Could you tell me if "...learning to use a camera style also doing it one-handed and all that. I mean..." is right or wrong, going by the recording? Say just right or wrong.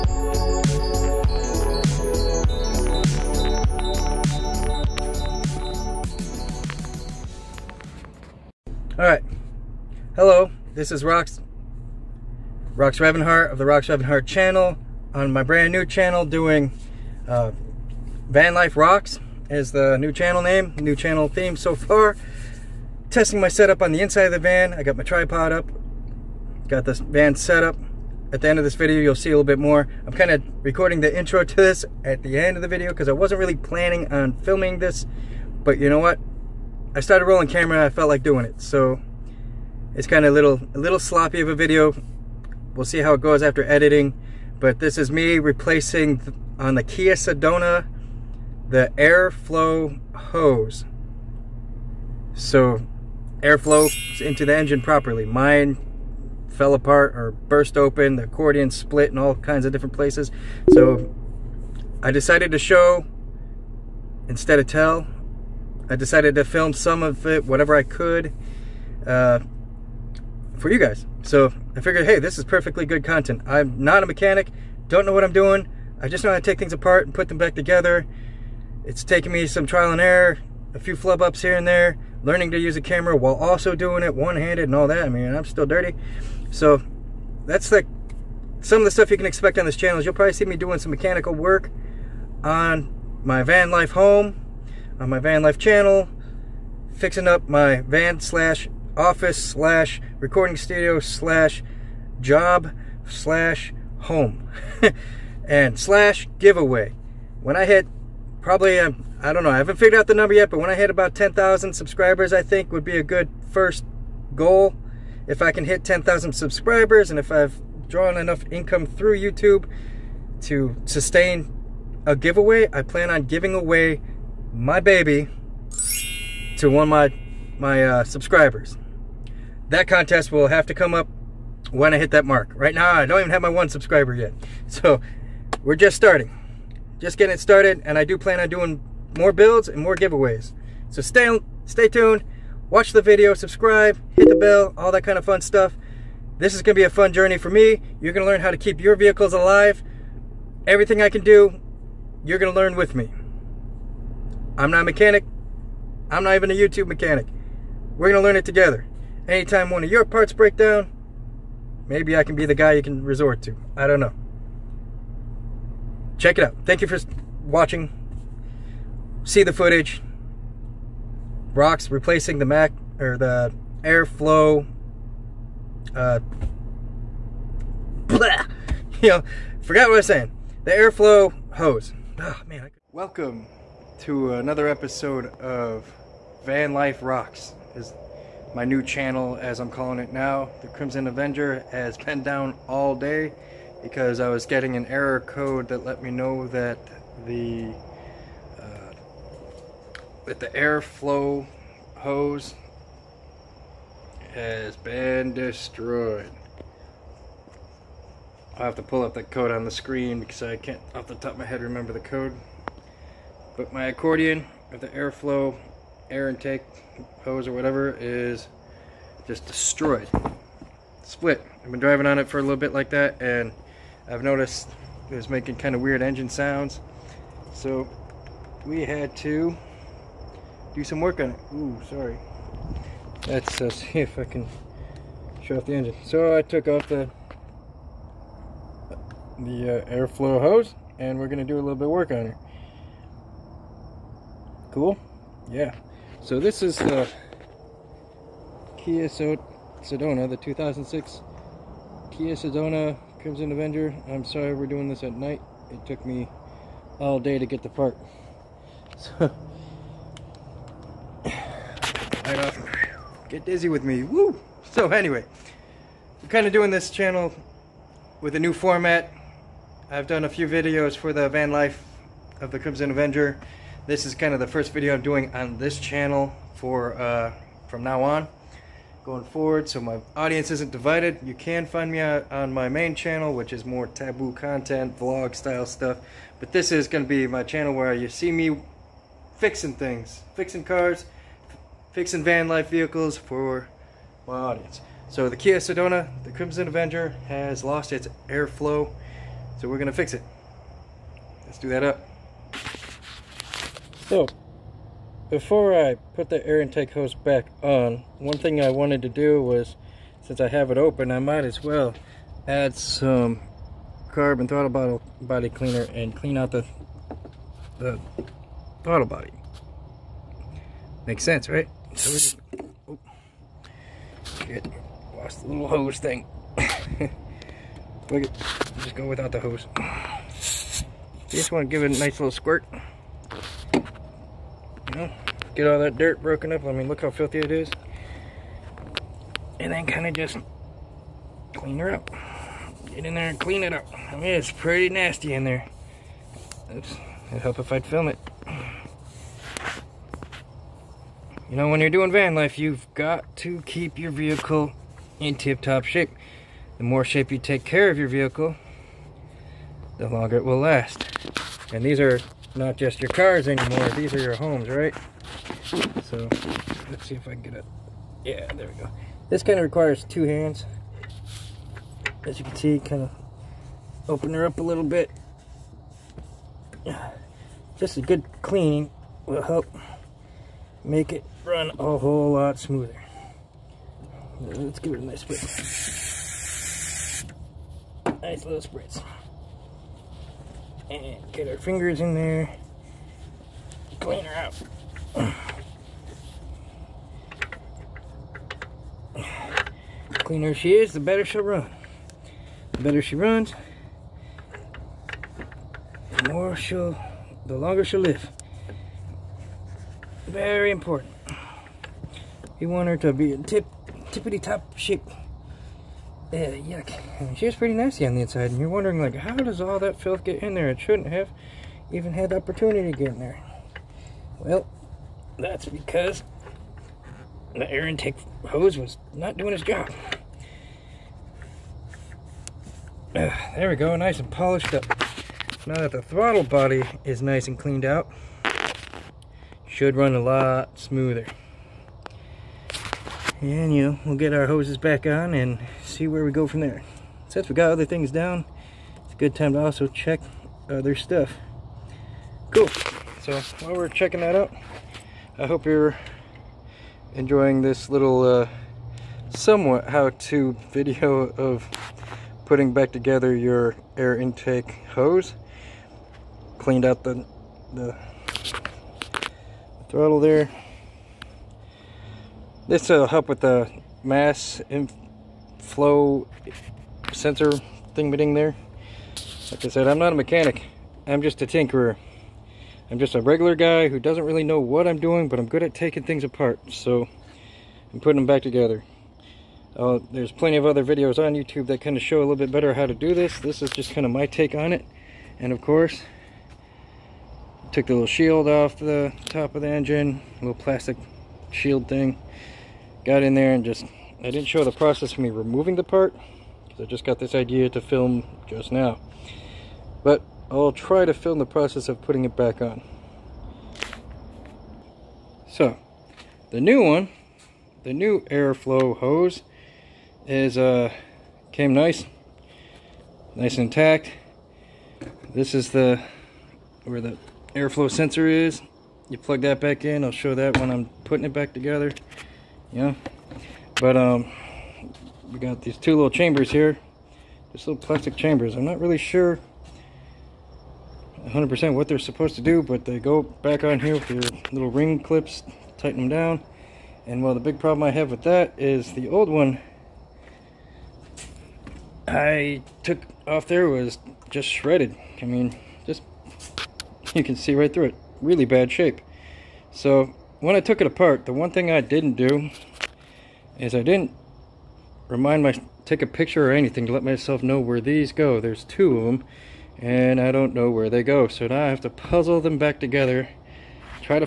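wrong.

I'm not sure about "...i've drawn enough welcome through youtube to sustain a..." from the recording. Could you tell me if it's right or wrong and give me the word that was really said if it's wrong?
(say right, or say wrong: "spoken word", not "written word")
wrong: "income", not "welcome".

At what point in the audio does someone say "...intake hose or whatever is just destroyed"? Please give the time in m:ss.
3:36.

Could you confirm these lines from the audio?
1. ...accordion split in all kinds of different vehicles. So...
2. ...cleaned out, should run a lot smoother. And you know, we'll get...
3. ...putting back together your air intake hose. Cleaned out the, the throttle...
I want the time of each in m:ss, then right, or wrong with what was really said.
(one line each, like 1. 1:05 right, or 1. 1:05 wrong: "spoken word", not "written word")
1. 0:58 wrong: "places", not "vehicles"
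2. 7:17 right
3. 7:42 right.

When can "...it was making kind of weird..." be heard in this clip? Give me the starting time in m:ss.
3:45.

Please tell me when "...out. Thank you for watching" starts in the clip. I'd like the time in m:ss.
2:46.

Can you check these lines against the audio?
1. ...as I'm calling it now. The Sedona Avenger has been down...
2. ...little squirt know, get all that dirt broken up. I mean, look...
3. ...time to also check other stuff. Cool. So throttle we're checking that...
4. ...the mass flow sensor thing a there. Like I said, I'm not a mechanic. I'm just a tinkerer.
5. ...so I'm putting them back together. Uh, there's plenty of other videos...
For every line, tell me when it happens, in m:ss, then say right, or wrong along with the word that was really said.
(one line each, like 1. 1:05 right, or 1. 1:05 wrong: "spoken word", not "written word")
1. 3:09 wrong: "Crimson", not "Sedona"
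2. 5:32 right
3. 7:29 wrong: "while", not "throttle"
4. 7:53 right
5. 8:06 right.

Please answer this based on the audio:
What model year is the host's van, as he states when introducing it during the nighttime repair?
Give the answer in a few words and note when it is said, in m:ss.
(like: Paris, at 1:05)
2006, at 4:10.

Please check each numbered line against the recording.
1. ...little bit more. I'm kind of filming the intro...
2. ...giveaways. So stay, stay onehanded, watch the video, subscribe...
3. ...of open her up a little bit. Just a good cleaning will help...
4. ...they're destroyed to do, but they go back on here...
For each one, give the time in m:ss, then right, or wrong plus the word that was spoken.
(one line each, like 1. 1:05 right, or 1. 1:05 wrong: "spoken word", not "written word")
1. 0:29 wrong: "recording", not "filming"
2. 2:19 wrong: "tuned", not "onehanded"
3. 6:13 right
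4. 9:01 wrong: "supposed", not "destroyed".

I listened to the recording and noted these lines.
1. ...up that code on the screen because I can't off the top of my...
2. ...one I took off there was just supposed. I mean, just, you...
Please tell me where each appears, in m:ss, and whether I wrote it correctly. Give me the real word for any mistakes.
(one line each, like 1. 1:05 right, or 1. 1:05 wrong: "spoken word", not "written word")
1. 3:29 right
2. 9:09 wrong: "shredded", not "supposed".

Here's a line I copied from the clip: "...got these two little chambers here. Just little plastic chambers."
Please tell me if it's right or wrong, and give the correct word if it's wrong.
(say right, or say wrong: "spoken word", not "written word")
right.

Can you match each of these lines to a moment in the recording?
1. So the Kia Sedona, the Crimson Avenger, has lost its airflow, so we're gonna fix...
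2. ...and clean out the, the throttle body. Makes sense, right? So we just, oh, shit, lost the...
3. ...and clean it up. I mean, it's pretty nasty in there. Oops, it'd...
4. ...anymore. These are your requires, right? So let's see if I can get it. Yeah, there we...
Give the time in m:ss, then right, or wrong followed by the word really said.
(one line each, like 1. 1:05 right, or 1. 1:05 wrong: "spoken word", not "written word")
1. 4:55 right
2. 5:15 right
3. 5:43 right
4. 6:03 wrong: "homes", not "requires".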